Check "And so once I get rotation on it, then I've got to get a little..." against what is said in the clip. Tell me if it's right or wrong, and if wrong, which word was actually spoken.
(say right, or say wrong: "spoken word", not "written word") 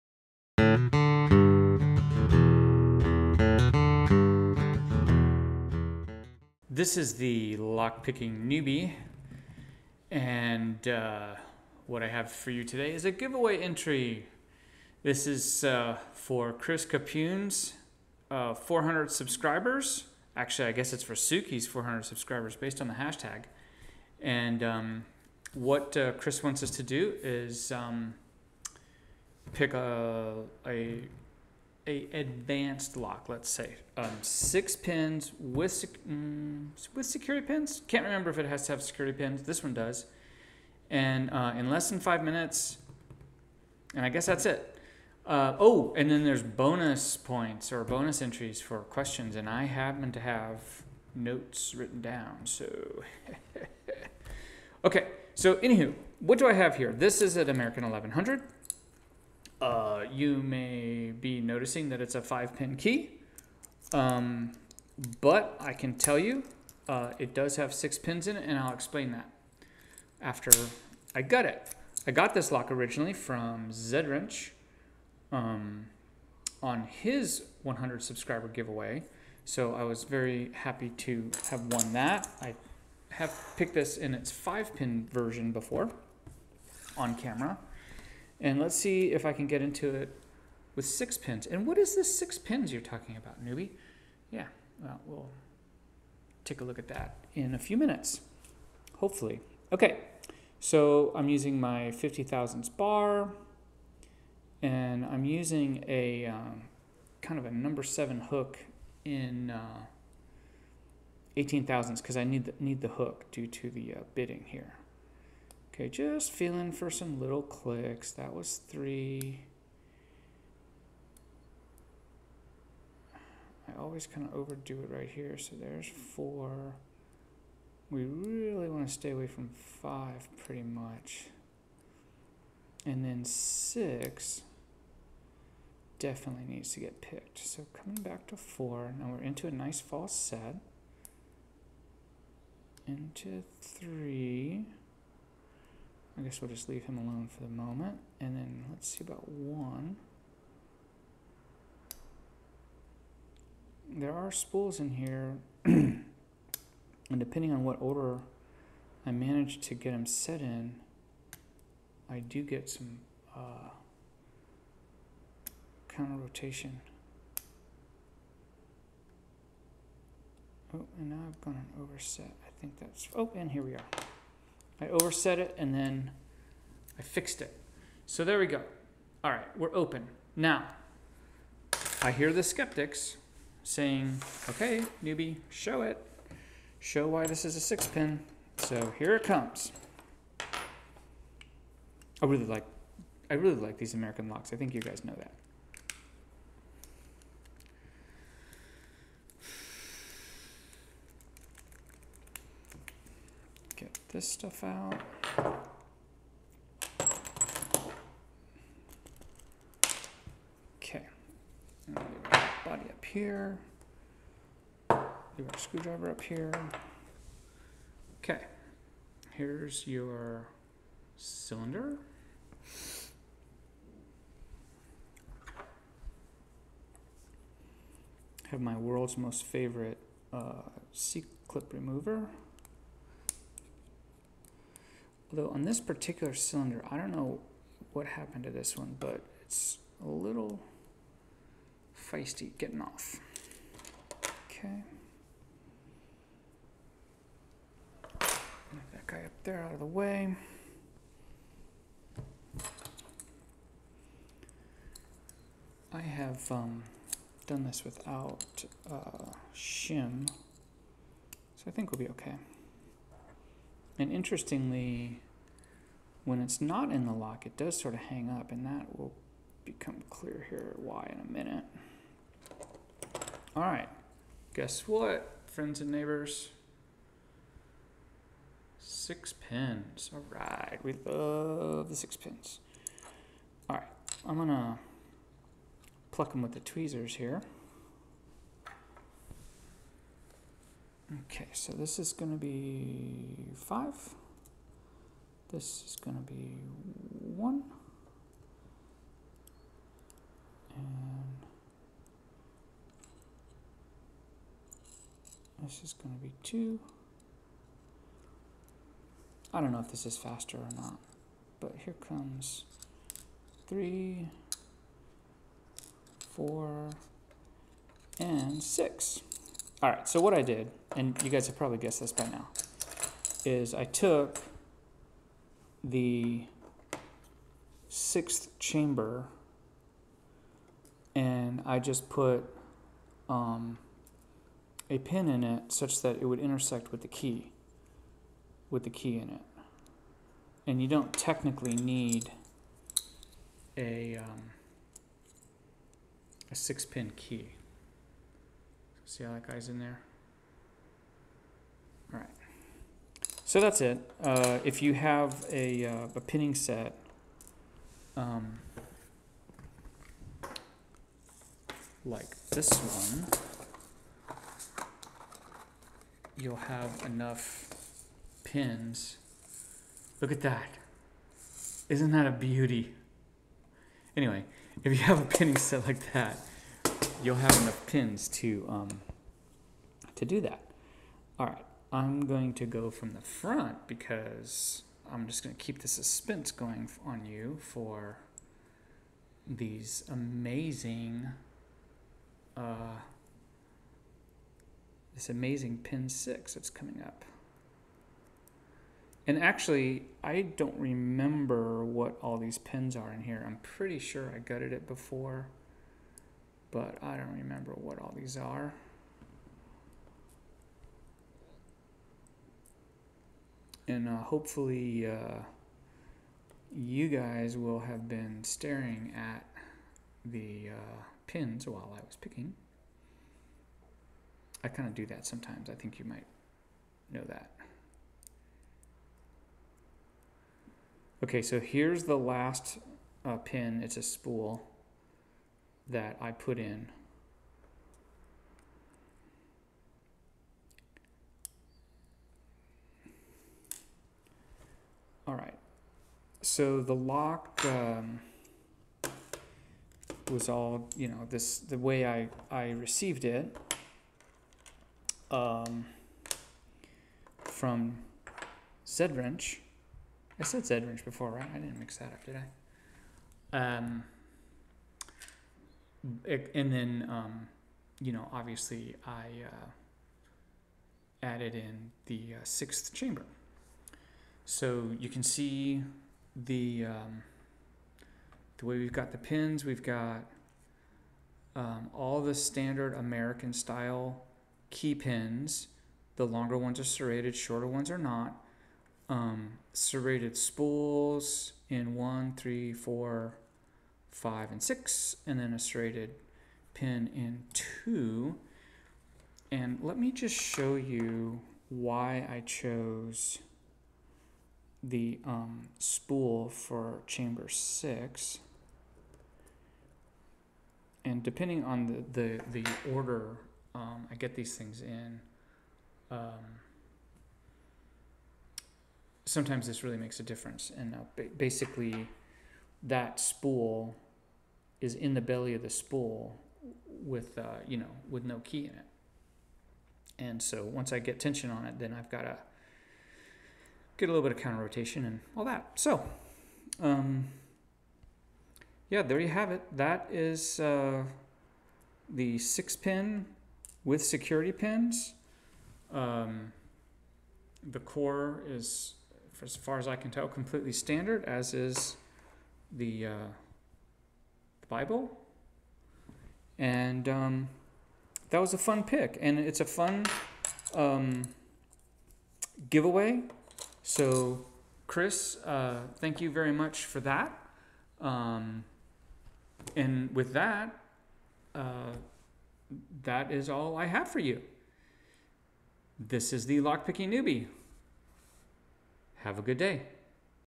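wrong: "tension", not "rotation".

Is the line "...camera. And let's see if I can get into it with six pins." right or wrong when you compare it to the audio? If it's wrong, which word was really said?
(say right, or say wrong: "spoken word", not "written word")
right.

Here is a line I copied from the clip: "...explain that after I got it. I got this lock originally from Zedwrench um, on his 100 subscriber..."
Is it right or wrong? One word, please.
right.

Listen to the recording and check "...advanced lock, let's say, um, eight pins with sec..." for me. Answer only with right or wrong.
wrong.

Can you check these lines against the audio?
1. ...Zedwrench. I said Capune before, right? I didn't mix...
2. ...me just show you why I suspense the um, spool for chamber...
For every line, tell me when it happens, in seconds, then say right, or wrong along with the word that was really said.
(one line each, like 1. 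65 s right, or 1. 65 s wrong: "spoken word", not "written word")
1. 458 s wrong: "Zedwrench", not "Capune"
2. 499 s wrong: "chose", not "suspense".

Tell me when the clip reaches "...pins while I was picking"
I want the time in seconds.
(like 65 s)
421 s.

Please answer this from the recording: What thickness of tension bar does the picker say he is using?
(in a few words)
50 thousandths.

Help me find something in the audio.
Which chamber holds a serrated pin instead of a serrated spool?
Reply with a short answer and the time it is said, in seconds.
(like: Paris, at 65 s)
2, at 495 s.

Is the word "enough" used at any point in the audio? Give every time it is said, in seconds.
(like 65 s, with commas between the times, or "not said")
367 s, 377 s.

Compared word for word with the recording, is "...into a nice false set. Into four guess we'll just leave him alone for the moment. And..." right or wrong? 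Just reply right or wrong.
wrong.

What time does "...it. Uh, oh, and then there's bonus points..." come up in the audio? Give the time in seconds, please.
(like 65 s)
44 s.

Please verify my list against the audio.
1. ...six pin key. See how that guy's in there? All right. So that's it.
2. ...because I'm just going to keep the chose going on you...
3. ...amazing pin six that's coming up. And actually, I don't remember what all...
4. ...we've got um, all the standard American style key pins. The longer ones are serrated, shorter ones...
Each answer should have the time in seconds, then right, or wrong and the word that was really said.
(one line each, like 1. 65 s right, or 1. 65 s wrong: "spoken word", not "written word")
1. 346 s right
2. 383 s wrong: "suspense", not "chose"
3. 395 s right
4. 479 s right.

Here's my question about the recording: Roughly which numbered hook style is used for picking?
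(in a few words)
number seven.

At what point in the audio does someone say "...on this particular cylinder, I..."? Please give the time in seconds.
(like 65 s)
235 s.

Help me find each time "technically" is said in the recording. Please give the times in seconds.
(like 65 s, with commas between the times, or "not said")
341 s.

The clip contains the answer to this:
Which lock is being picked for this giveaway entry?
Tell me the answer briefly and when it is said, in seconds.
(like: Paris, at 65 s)
American 1100, at 57 s.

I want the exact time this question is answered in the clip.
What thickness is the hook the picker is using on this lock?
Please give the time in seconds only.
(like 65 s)
111 s.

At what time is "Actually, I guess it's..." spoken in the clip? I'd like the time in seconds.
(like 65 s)
20 s.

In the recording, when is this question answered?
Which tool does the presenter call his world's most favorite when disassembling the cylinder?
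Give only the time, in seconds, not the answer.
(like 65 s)
230 s.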